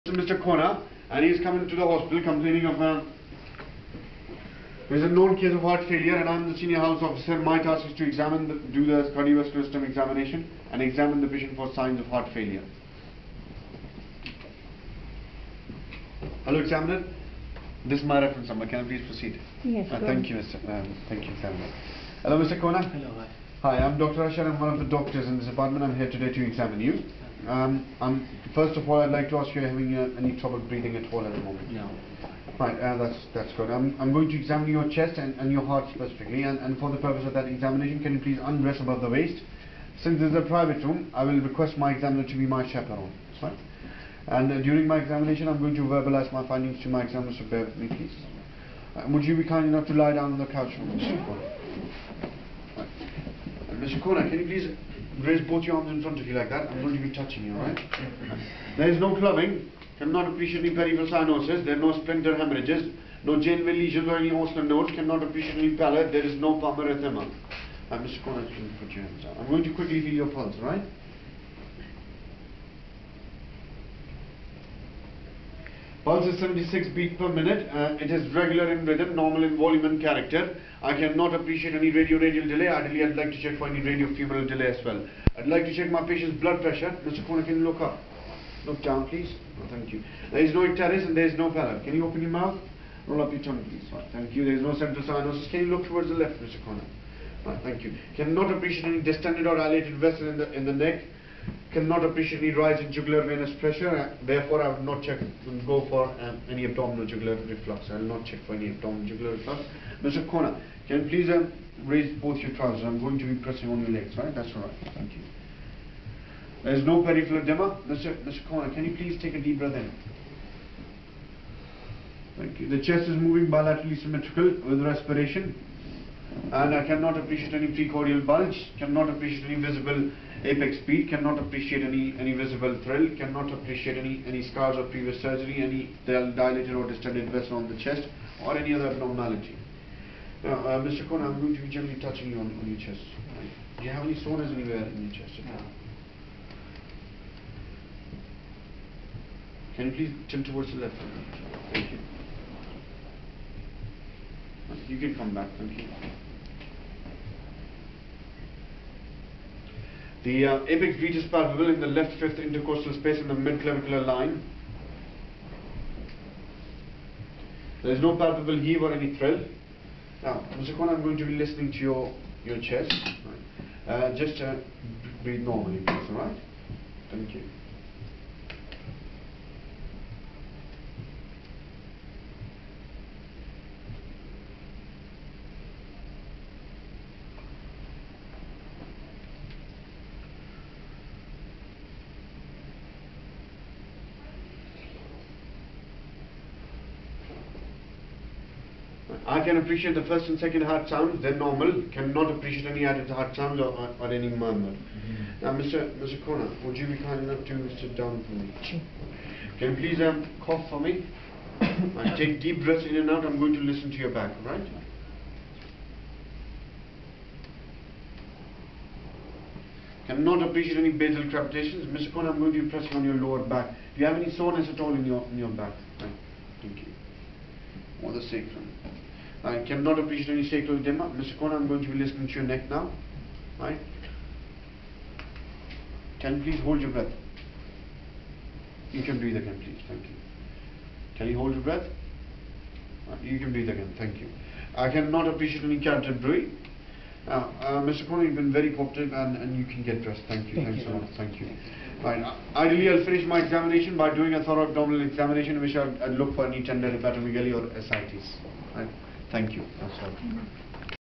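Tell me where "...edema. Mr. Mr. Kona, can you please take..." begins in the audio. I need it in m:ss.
1:57.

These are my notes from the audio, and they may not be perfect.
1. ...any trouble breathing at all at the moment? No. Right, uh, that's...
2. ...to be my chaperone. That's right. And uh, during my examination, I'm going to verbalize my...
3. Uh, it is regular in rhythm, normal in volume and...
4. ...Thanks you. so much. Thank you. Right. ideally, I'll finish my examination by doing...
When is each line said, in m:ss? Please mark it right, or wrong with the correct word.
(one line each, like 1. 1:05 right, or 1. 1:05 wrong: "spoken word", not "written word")
1. 0:30 right
2. 0:42 right
3. 1:17 right
4. 4:10 right.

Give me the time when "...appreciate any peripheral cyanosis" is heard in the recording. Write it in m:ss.
1:00.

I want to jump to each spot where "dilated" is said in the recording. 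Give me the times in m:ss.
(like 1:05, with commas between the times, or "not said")
1:39, 2:16.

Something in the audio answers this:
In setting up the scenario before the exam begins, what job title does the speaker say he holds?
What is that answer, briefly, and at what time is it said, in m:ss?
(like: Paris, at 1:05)
Senior house officer, at 0:06.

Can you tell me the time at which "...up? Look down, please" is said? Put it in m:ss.
1:27.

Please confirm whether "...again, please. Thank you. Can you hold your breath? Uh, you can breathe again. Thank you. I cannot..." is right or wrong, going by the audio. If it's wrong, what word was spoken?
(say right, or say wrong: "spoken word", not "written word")
right.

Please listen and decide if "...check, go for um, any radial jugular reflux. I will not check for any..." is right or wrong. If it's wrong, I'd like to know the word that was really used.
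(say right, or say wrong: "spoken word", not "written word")
wrong: "abdominal", not "radial".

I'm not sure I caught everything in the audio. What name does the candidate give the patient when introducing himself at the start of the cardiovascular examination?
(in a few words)
Dr. Ashar.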